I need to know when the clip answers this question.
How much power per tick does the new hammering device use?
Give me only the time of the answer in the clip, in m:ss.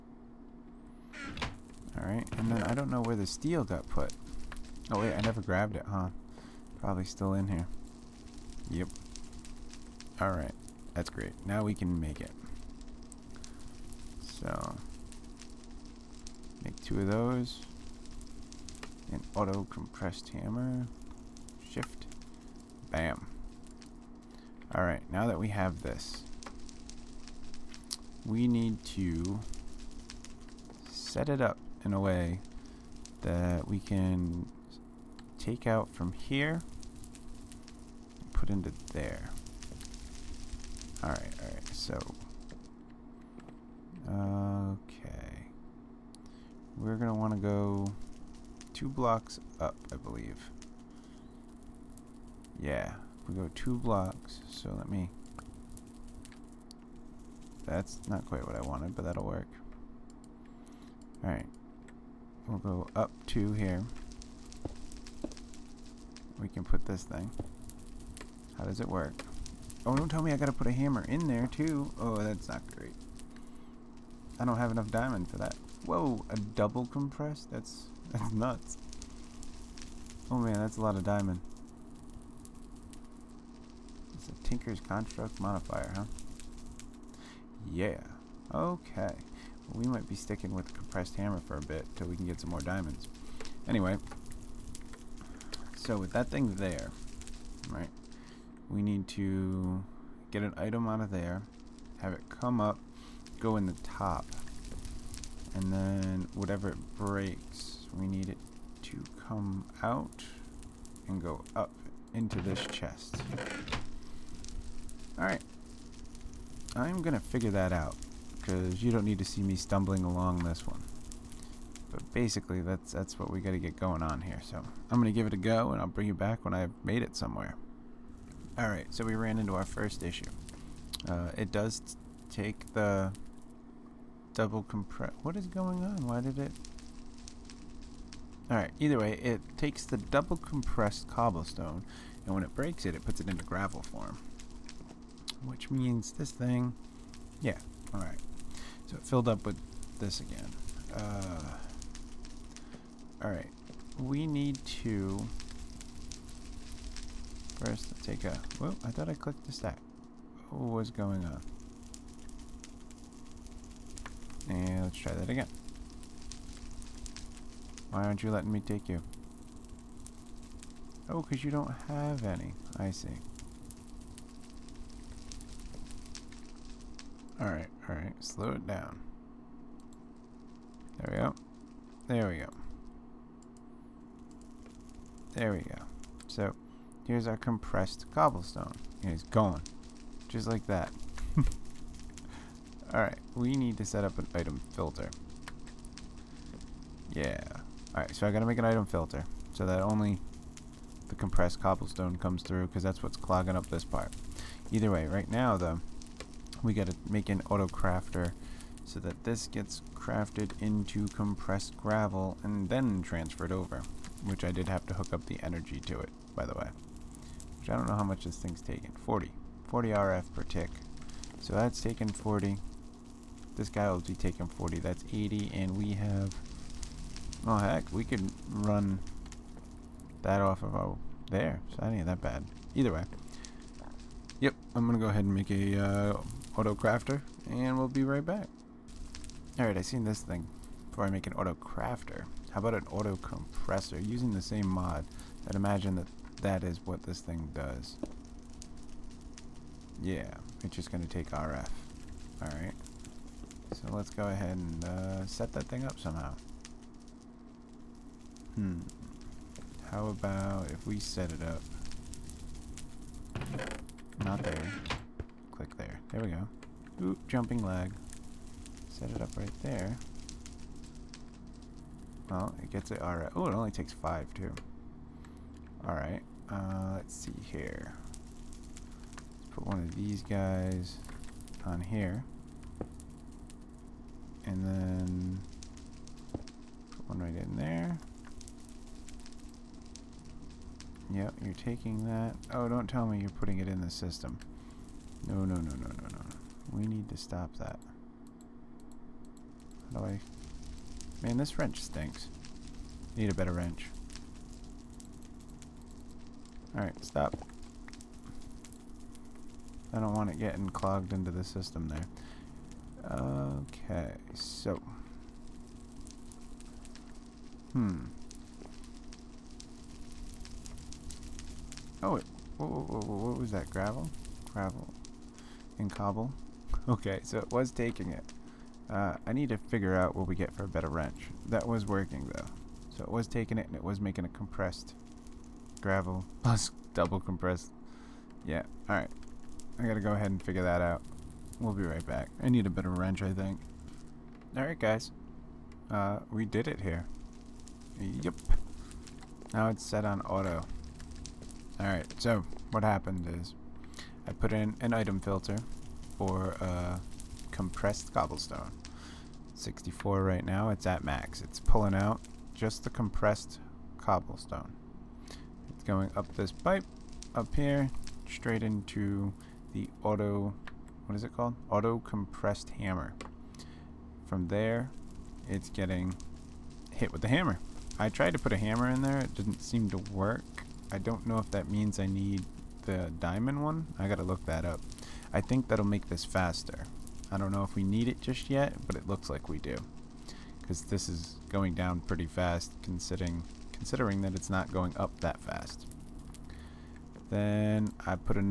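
3:39.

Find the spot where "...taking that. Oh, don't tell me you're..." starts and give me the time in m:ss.
4:51.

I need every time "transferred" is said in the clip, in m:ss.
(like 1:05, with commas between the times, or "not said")
3:33.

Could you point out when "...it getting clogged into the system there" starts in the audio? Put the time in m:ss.
5:10.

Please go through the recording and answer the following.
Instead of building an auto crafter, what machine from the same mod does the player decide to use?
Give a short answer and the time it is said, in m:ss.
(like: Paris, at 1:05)
auto compressor, at 4:02.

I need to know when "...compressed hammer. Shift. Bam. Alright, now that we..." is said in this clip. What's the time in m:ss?
0:19.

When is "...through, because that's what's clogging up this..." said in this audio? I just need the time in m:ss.
3:22.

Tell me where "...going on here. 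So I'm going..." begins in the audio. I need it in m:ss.
2:03.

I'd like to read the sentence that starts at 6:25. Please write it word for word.
I think that'll make this faster.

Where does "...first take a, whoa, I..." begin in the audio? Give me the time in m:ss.
2:37.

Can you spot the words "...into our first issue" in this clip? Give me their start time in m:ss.
2:09.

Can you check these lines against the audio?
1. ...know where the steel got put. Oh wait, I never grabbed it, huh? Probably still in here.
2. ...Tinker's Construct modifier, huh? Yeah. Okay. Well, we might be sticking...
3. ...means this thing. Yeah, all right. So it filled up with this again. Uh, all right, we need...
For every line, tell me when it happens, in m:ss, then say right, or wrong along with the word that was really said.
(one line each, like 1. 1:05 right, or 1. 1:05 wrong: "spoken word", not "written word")
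1. 0:02 right
2. 1:24 right
3. 2:25 right.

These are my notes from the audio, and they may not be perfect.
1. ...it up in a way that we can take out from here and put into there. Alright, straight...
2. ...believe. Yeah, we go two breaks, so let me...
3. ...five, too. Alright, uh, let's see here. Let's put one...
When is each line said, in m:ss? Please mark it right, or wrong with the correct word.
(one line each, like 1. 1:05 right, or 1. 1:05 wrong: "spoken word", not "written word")
1. 0:31 wrong: "alright", not "straight"
2. 0:49 wrong: "blocks", not "breaks"
3. 4:33 right.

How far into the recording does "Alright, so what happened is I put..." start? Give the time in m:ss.
5:51.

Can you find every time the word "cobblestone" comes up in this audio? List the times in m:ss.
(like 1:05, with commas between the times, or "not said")
2:21, 3:08, 3:21, 5:58, 6:03.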